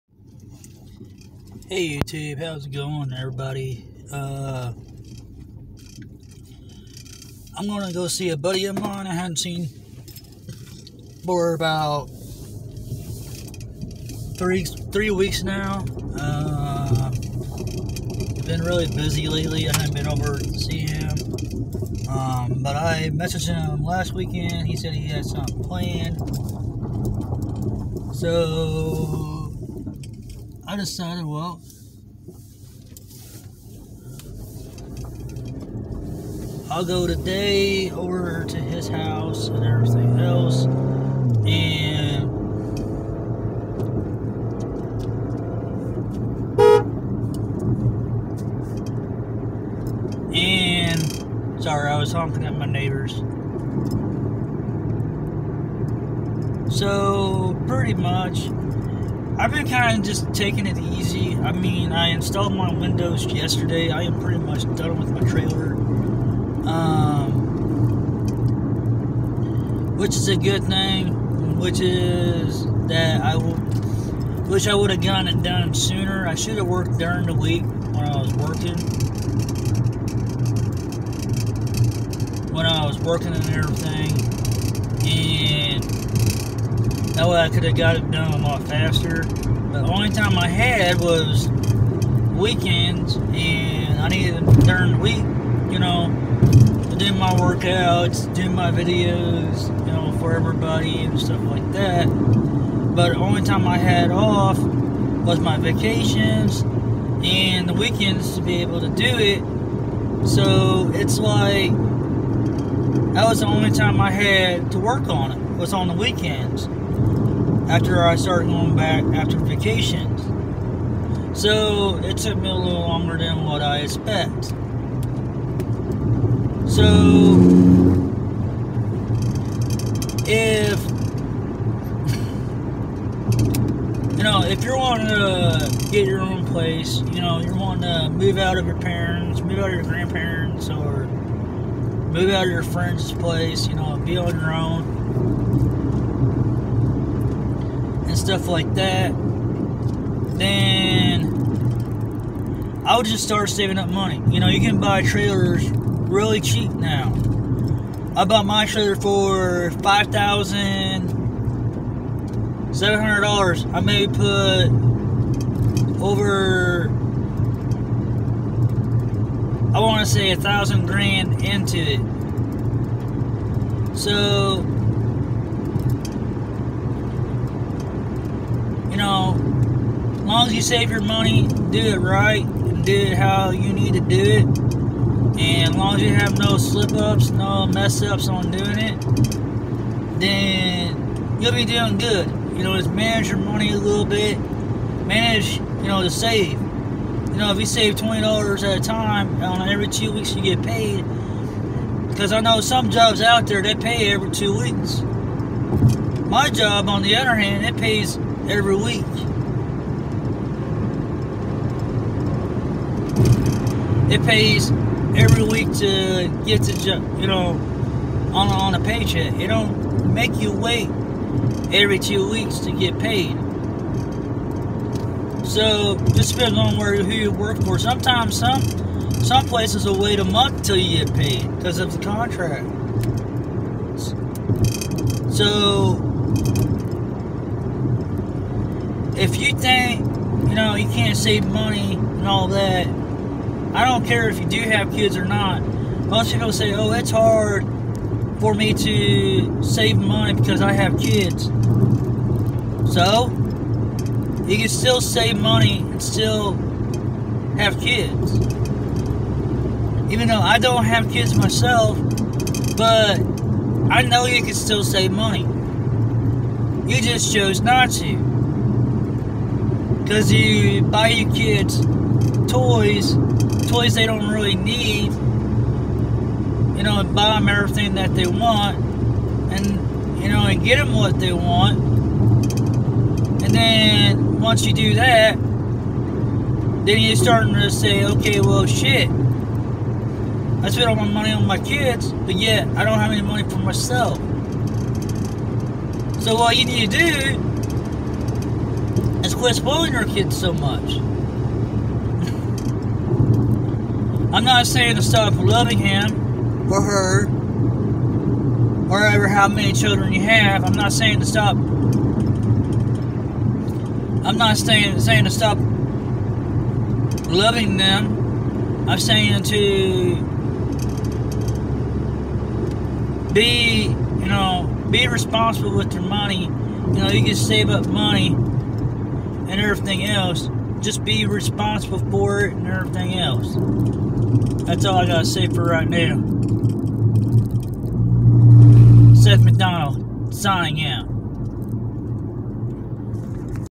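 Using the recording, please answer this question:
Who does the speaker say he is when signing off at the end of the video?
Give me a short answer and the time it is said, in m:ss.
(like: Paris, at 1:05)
Seth McDonald, at 5:39.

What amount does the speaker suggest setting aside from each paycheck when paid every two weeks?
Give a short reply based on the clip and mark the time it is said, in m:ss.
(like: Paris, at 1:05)
$20, at 3:17.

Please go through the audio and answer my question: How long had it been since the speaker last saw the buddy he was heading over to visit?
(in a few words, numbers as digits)
3 weeks.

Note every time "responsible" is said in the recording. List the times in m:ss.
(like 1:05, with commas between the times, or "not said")
5:25, 5:31.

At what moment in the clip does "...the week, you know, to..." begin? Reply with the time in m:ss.
1:34.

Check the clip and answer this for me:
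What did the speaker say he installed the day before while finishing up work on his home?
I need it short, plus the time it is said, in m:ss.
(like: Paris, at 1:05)
windows, at 1:02.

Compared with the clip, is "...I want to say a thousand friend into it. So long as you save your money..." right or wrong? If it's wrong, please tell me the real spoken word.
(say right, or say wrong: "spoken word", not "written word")
wrong: "grand", not "friend".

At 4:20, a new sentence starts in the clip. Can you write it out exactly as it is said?
Even though I don't have kids myself, but I know you can still save money.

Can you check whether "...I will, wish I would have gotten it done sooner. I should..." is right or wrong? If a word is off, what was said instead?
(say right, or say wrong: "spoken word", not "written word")
right.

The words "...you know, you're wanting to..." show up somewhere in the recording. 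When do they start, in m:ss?
2:17.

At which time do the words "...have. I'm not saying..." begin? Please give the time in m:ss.
5:10.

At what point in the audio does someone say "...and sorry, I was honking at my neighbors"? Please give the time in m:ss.
0:50.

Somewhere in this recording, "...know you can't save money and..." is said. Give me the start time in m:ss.
4:00.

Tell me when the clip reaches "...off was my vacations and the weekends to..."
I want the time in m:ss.
1:44.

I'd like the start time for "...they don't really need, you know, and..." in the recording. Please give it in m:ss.
4:33.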